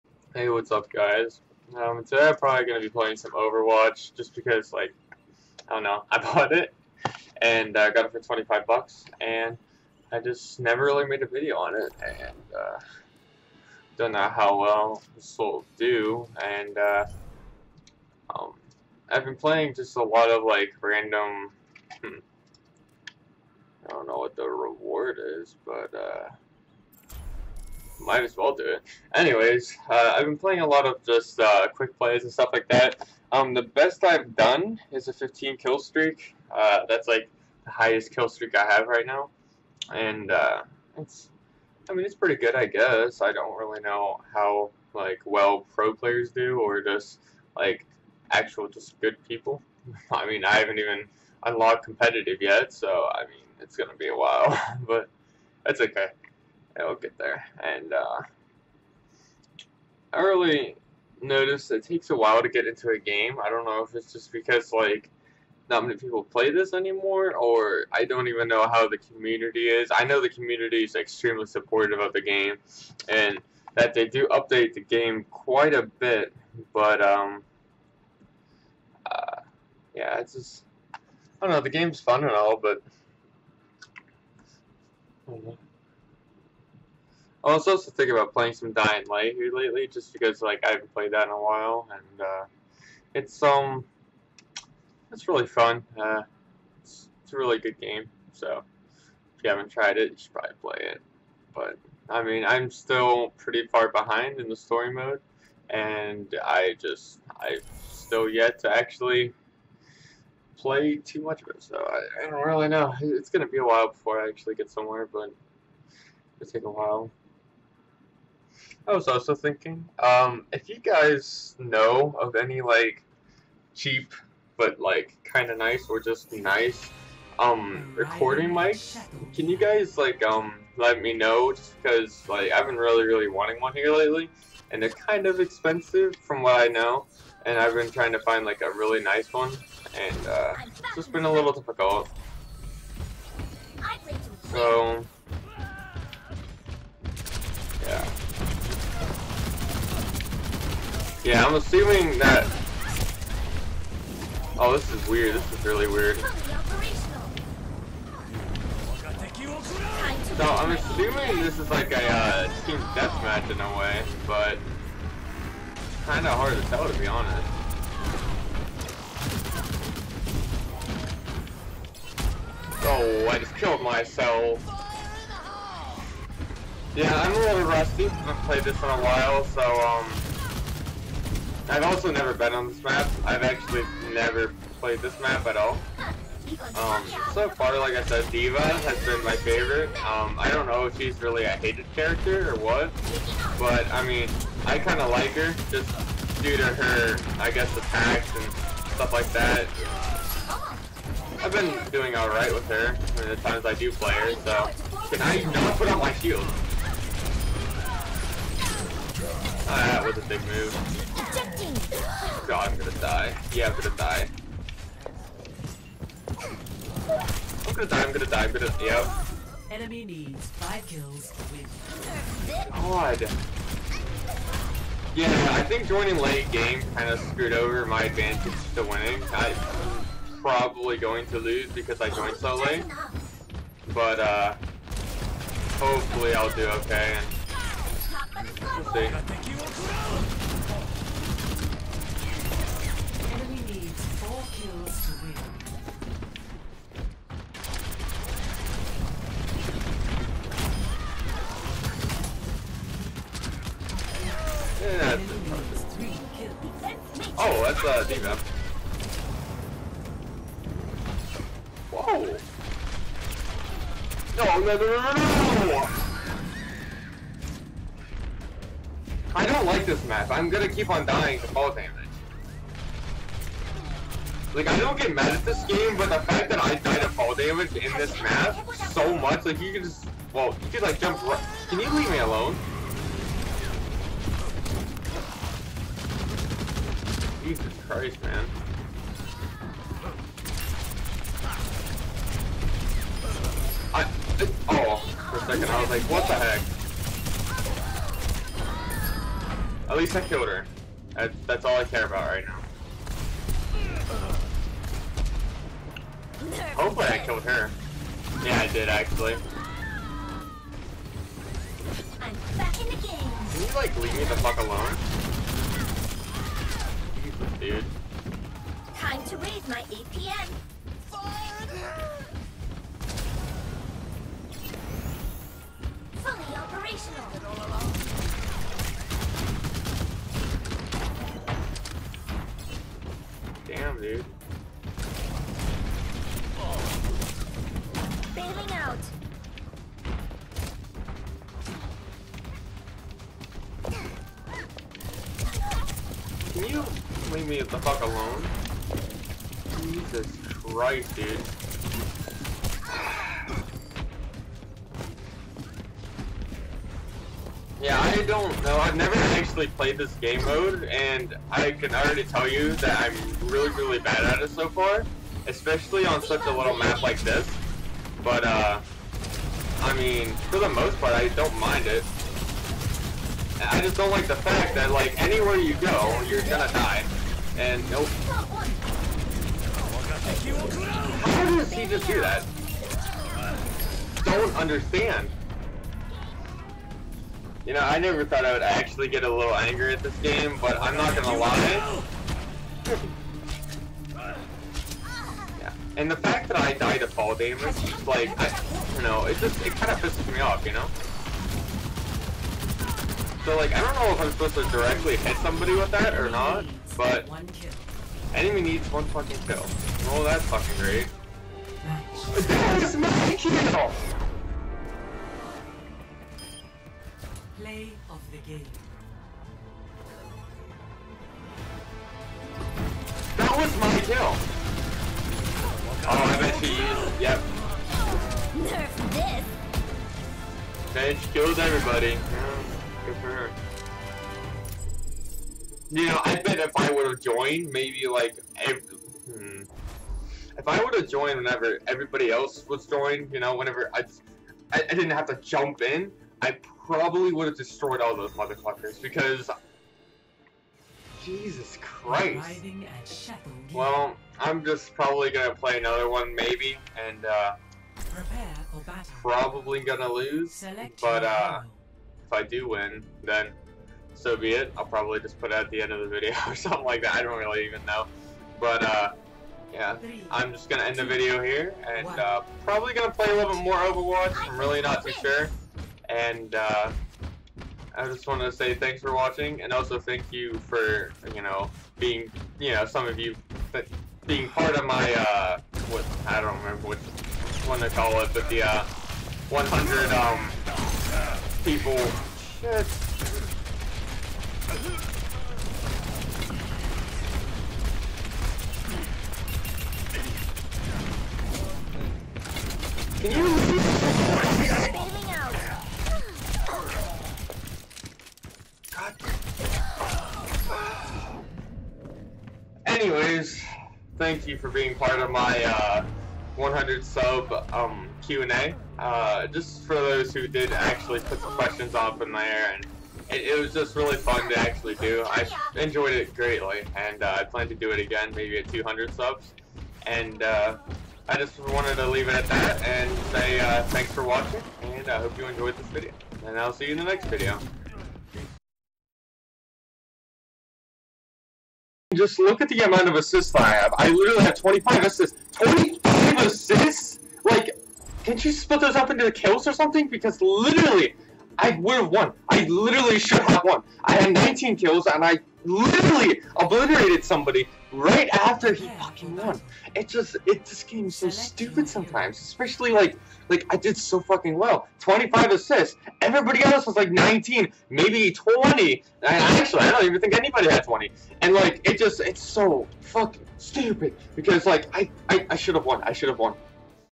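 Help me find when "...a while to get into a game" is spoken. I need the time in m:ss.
1:02.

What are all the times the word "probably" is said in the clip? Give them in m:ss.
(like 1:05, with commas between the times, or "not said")
0:02, 1:40, 3:50, 7:26, 7:34, 7:39, 7:44, 7:52.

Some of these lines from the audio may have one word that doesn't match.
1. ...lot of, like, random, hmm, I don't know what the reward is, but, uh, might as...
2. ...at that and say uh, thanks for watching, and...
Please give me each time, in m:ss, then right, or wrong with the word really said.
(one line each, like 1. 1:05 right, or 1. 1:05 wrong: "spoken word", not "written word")
1. 0:20 right
2. 8:52 right.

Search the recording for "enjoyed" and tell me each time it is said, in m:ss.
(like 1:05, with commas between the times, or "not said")
8:45, 8:55.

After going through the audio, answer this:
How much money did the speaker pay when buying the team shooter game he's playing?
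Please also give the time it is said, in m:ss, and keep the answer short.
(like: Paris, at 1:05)
25 bucks, at 0:08.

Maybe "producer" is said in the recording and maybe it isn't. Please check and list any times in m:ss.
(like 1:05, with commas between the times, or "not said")
not said.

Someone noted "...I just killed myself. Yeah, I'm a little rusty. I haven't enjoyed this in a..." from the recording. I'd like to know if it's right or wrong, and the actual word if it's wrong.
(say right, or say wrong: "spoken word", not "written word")
wrong: "played", not "enjoyed".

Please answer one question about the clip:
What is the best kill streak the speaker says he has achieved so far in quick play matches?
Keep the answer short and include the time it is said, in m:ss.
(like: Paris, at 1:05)
15, at 0:35.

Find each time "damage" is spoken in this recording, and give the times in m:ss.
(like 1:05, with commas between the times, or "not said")
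4:31, 4:37, 6:37.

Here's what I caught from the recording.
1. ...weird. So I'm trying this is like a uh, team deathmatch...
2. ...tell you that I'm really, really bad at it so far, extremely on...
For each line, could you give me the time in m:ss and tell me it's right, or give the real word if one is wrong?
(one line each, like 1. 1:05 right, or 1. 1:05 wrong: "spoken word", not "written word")
1. 2:35 wrong: "assuming", not "trying"
2. 6:02 wrong: "especially", not "extremely".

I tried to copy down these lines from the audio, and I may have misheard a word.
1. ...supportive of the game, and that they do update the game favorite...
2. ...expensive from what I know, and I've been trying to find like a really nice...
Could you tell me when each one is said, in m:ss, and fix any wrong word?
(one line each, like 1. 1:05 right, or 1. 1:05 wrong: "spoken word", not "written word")
1. 1:11 wrong: "quite", not "favorite"
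2. 2:15 right.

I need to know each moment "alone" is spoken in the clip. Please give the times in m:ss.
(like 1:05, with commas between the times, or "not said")
4:42, 5:14, 5:48.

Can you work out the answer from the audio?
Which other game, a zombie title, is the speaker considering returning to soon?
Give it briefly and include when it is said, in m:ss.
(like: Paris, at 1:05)
Dying Light, at 1:28.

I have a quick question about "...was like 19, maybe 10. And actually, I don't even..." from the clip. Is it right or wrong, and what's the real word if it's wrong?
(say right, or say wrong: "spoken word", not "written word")
wrong: "20", not "10".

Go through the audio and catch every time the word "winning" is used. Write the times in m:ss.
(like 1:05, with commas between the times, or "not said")
3:48.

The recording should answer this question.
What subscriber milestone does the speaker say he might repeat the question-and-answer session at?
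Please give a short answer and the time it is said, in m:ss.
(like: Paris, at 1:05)
200 subs, at 8:48.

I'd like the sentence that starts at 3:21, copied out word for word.
I've been doing alright with her I mean, the times I do play her, so...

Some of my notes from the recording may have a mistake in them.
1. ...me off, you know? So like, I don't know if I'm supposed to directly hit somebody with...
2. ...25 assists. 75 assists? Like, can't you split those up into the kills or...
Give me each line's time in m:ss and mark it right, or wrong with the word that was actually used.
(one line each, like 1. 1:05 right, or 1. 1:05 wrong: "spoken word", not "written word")
1. 6:40 right
2. 9:04 wrong: "25", not "75".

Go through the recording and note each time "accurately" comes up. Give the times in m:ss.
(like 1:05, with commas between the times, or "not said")
not said.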